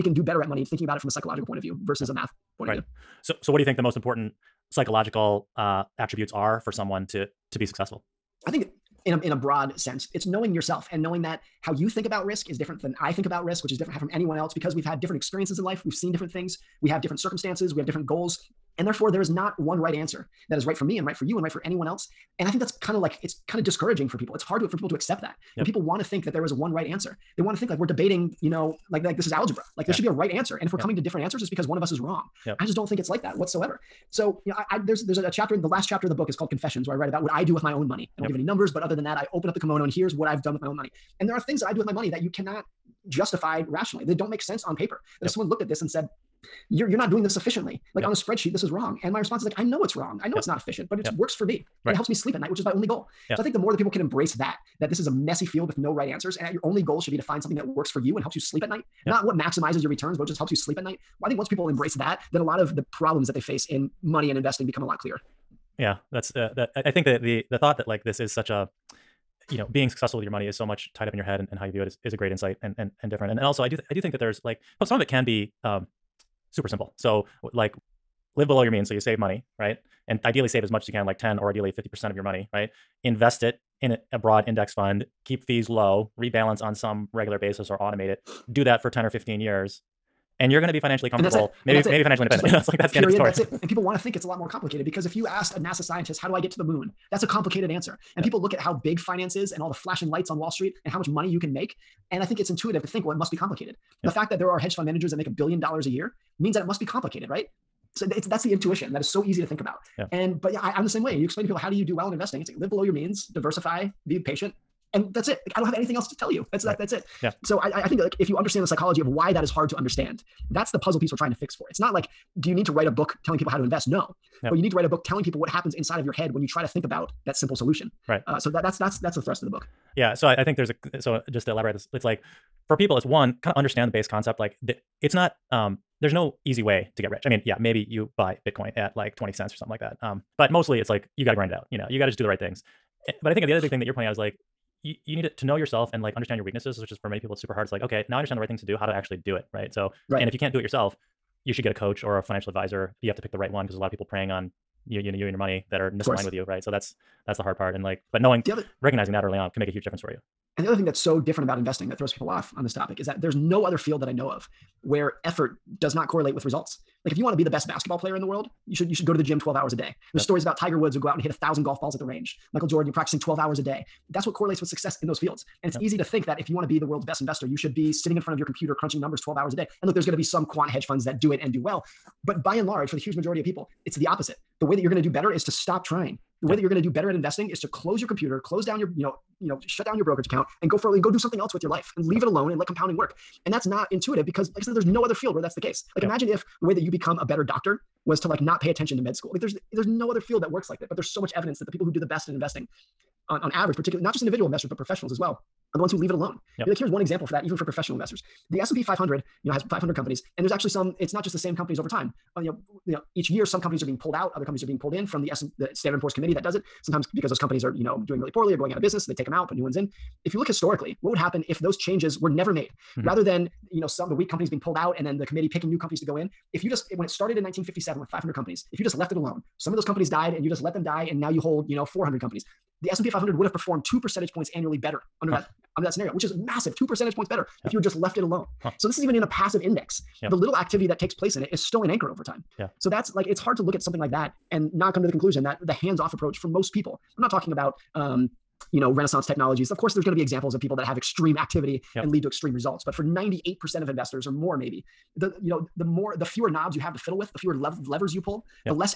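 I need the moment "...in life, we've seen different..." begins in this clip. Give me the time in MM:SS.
00:15.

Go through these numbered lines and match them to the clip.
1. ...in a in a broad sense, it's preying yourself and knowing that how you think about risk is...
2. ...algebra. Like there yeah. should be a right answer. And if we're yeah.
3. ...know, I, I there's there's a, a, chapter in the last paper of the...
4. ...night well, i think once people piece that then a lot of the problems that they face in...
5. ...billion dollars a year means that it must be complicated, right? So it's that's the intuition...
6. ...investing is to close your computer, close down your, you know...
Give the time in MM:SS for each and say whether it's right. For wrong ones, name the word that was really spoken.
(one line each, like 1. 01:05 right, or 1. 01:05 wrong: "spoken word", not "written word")
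1. 00:09 wrong: "knowing", not "preying"
2. 00:29 right
3. 00:34 wrong: "chapter", not "paper"
4. 01:00 wrong: "embrace", not "piece"
5. 01:45 right
6. 03:07 right.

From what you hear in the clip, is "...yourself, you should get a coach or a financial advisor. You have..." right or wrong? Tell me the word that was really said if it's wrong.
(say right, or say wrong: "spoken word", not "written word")
right.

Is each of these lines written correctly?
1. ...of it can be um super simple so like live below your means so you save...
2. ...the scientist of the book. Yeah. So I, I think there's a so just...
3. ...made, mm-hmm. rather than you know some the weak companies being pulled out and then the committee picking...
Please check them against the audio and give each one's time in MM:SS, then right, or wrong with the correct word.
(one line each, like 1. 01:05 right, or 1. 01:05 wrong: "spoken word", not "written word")
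1. 01:14 right
2. 02:09 wrong: "thrust", not "scientist"
3. 03:42 right.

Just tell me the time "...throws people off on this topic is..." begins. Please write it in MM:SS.
02:41.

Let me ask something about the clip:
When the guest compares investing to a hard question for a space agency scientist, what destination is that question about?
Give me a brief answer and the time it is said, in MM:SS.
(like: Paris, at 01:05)
the moon, at 01:36.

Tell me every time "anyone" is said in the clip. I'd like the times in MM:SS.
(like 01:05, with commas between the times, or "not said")
00:14, 00:21.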